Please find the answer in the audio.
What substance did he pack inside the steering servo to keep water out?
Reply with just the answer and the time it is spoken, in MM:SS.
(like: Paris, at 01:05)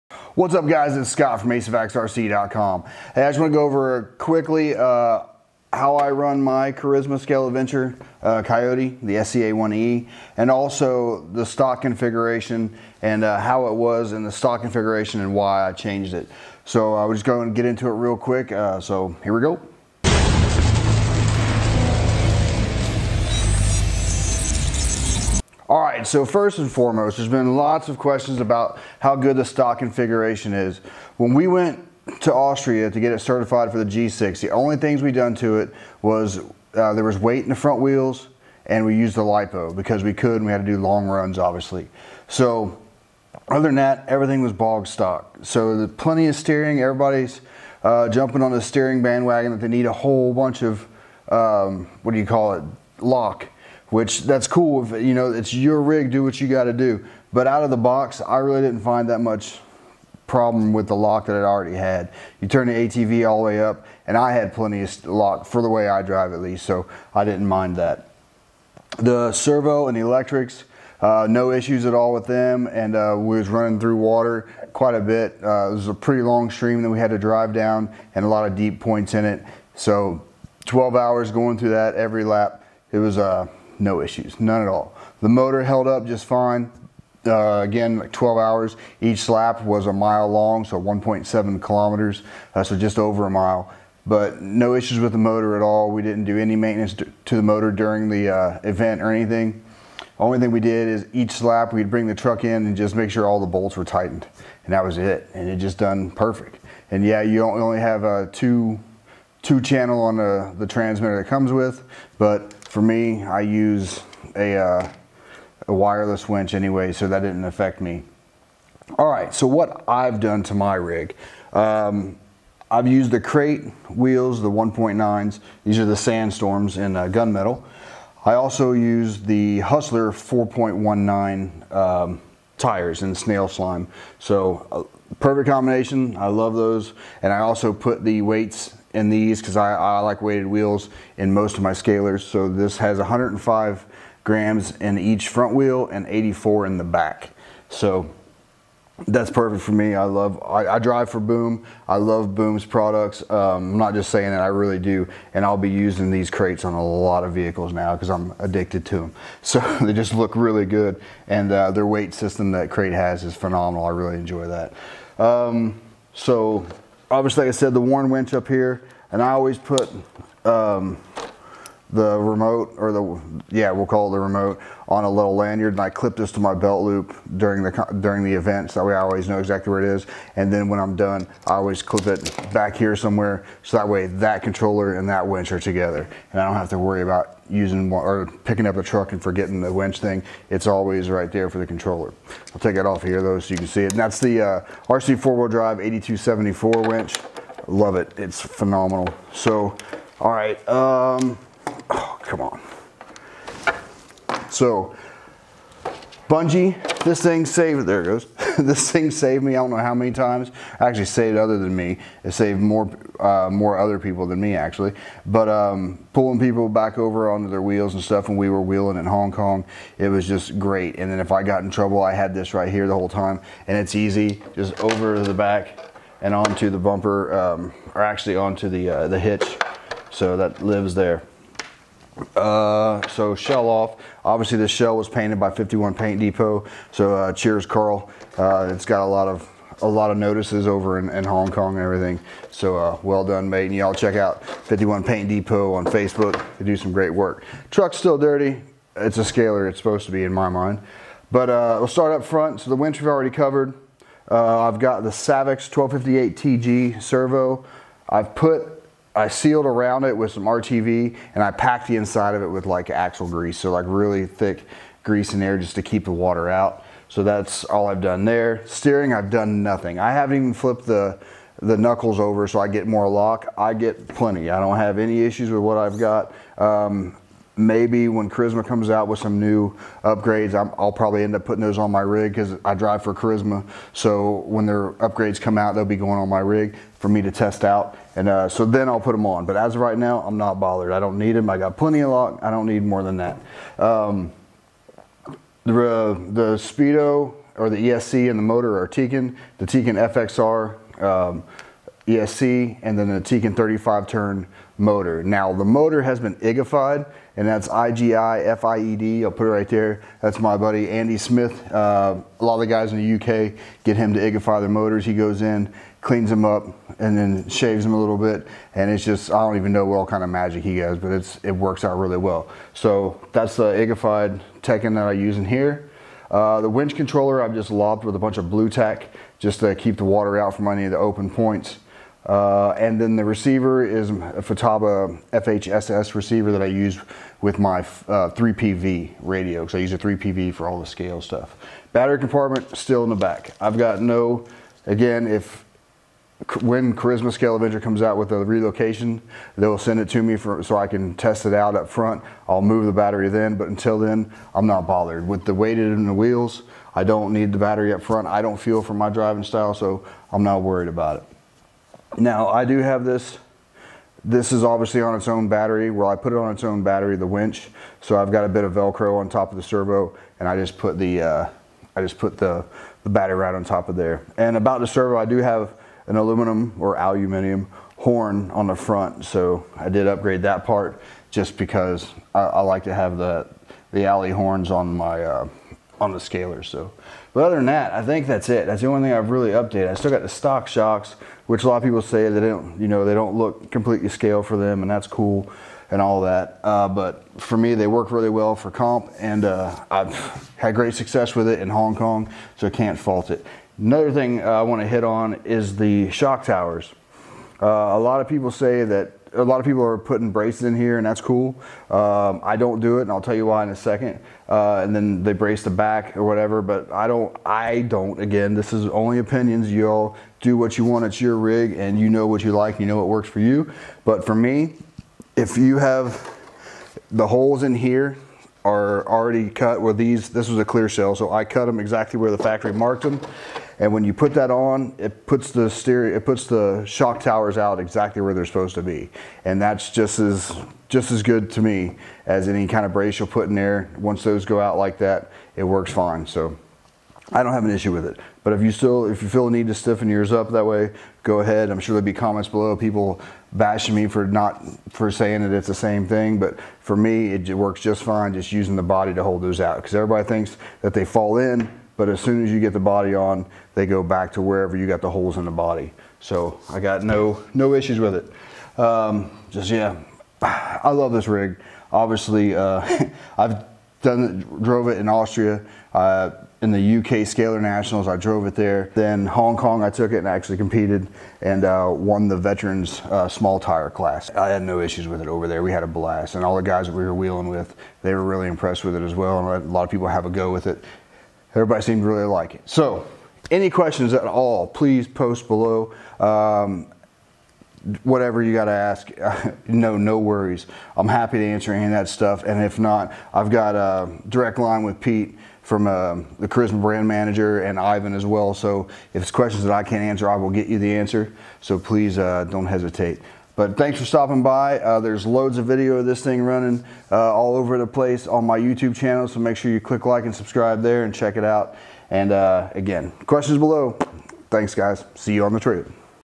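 axle grease, at 04:22.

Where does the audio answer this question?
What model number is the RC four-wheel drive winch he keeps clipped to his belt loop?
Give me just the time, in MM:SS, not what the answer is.
03:15.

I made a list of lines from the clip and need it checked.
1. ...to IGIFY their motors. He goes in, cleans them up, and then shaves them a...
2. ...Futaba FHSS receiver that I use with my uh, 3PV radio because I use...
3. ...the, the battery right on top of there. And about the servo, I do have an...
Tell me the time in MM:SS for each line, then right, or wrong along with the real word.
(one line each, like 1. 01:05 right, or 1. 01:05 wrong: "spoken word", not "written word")
1. 05:14 right
2. 05:34 right
3. 06:12 right.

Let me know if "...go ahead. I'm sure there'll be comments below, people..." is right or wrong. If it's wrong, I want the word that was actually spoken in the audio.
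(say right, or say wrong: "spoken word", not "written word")
right.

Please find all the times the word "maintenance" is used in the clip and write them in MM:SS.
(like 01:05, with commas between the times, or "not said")
01:36.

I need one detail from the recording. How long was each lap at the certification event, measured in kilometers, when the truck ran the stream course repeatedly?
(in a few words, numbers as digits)
1.7 kilometers.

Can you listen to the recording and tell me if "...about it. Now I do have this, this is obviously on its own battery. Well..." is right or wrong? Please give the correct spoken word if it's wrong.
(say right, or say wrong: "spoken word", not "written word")
right.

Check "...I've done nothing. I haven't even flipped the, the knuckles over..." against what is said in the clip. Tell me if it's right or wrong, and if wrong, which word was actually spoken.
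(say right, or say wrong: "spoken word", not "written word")
right.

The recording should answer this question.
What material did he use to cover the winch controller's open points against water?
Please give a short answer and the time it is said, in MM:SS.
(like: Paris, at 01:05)
blue tack, at 05:28.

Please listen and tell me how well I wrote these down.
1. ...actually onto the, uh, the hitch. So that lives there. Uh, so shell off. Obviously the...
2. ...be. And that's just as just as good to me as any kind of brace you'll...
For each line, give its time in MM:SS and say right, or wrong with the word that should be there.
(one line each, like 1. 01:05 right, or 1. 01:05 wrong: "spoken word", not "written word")
1. 03:48 right
2. 07:18 right.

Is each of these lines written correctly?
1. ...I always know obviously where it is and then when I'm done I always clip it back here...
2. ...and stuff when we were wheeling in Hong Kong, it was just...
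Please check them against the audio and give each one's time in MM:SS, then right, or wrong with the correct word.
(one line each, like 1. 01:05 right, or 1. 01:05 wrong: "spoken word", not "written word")
1. 02:58 wrong: "exactly", not "obviously"
2. 03:37 right.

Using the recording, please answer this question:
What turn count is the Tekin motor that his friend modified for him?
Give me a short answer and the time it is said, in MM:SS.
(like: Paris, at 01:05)
35 turn, at 05:03.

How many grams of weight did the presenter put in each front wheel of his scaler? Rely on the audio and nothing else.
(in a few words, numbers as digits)
105 grams.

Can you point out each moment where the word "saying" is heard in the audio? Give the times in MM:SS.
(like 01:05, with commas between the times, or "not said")
02:34, 07:35.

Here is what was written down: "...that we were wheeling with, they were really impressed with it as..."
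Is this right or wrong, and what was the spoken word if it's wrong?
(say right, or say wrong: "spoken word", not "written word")
right.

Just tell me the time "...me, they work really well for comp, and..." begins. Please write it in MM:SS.
06:37.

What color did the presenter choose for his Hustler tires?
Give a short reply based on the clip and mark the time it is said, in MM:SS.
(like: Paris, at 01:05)
snail slime, at 02:13.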